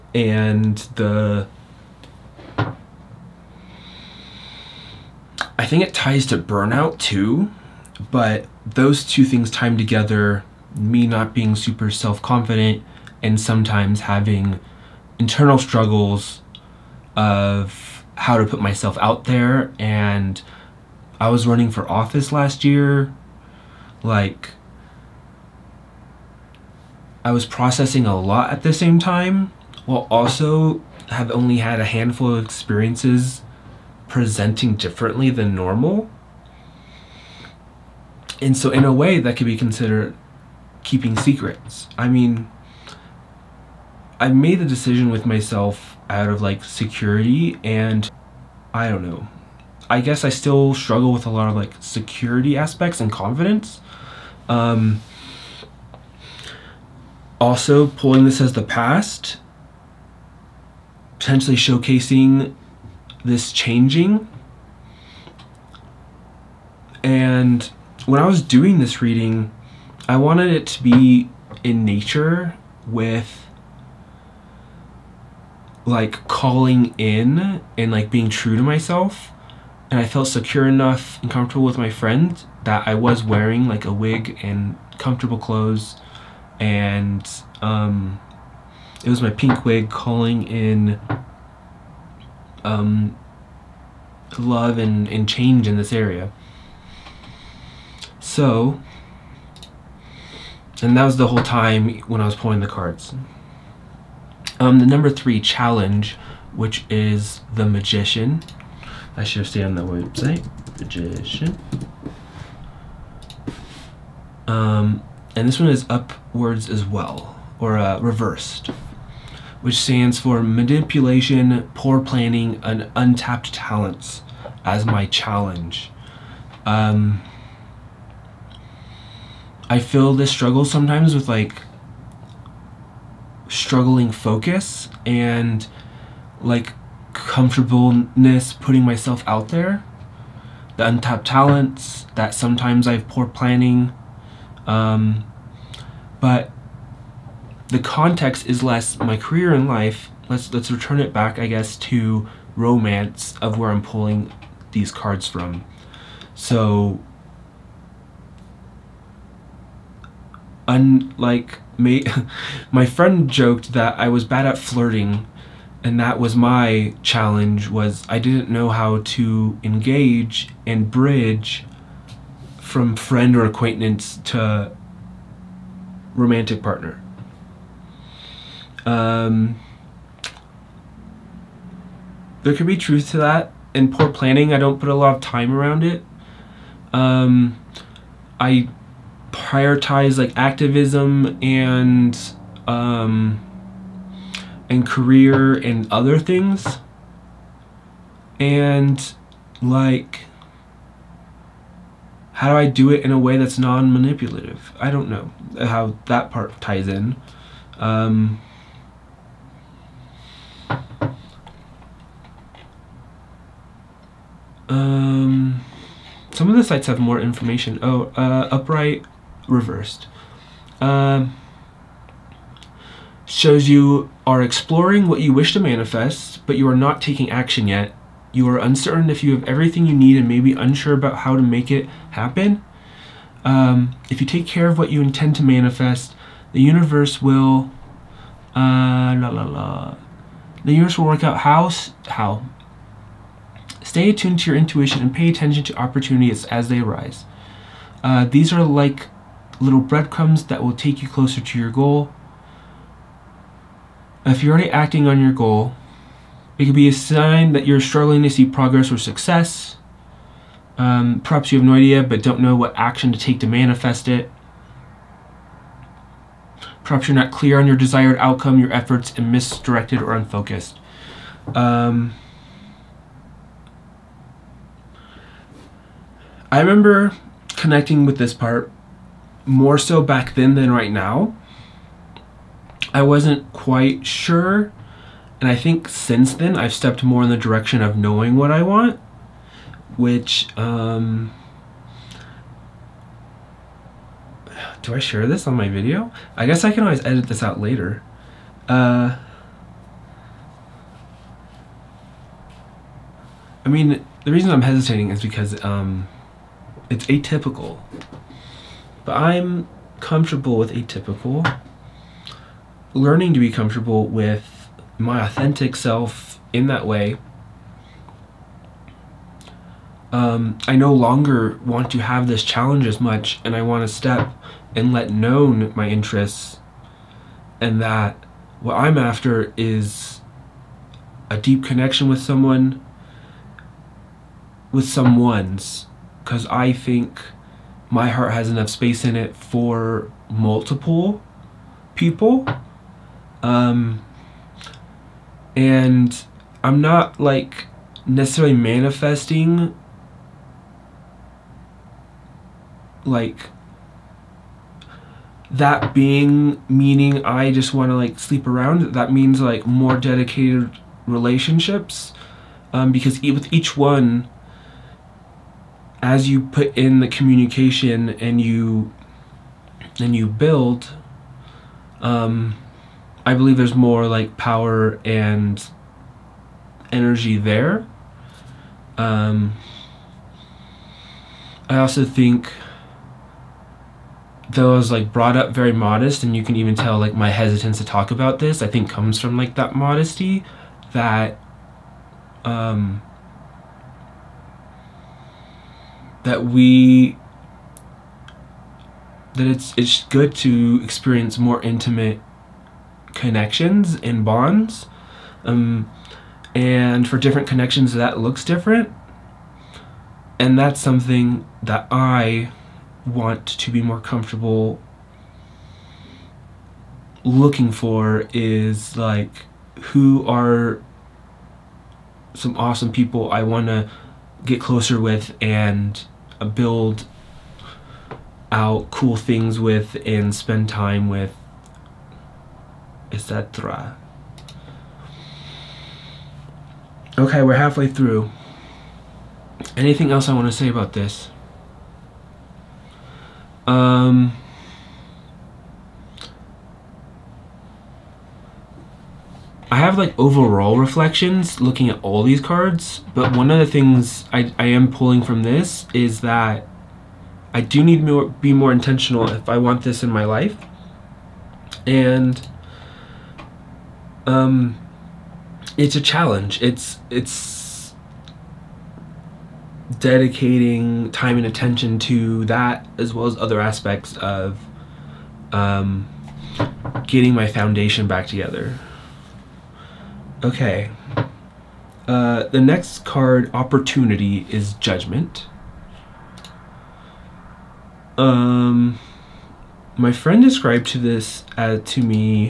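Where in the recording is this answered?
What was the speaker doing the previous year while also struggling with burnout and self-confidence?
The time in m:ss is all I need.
0:21.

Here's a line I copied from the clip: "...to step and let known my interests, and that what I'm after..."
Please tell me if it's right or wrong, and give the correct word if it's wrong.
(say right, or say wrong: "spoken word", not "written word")
right.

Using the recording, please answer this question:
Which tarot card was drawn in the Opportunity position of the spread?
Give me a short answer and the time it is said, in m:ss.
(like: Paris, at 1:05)
Judgment, at 8:04.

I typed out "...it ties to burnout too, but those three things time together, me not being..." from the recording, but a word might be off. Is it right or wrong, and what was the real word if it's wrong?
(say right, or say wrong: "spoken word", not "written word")
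wrong: "two", not "three".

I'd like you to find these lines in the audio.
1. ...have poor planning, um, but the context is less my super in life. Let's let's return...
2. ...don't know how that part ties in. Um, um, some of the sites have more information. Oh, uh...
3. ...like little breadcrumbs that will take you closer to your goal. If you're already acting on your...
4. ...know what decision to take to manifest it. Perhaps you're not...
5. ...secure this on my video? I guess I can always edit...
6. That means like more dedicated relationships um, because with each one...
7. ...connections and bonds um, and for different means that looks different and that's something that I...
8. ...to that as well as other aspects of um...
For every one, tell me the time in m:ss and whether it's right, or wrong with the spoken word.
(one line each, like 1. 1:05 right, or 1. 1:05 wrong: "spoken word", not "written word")
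1. 2:22 wrong: "career", not "super"
2. 3:24 right
3. 4:08 right
4. 4:22 wrong: "action", not "decision"
5. 4:54 wrong: "share", not "secure"
6. 5:58 right
7. 6:43 wrong: "connections", not "means"
8. 7:51 right.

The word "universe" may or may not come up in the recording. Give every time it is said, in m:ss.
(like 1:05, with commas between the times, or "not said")
3:56, 4:00.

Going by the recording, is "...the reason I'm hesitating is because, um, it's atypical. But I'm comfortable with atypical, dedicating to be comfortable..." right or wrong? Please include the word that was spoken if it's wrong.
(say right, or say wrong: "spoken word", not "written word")
wrong: "learning", not "dedicating".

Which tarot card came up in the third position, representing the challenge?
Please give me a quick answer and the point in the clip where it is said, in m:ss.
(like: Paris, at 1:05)
The Magician, at 1:47.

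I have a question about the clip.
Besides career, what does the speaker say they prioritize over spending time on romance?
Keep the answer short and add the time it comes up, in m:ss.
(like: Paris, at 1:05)
Activism, at 3:10.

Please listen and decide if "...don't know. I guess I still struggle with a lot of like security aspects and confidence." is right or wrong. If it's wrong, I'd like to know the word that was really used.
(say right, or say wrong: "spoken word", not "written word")
right.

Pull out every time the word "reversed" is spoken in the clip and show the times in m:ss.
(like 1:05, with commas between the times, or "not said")
1:58, 3:39.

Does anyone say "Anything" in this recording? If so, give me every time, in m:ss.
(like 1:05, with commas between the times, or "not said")
7:19.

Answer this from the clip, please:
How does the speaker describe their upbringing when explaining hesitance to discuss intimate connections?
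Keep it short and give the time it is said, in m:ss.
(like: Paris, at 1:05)
Very modest, at 6:25.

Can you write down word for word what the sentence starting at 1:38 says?
So and that was the whole time when I was pulling the cards.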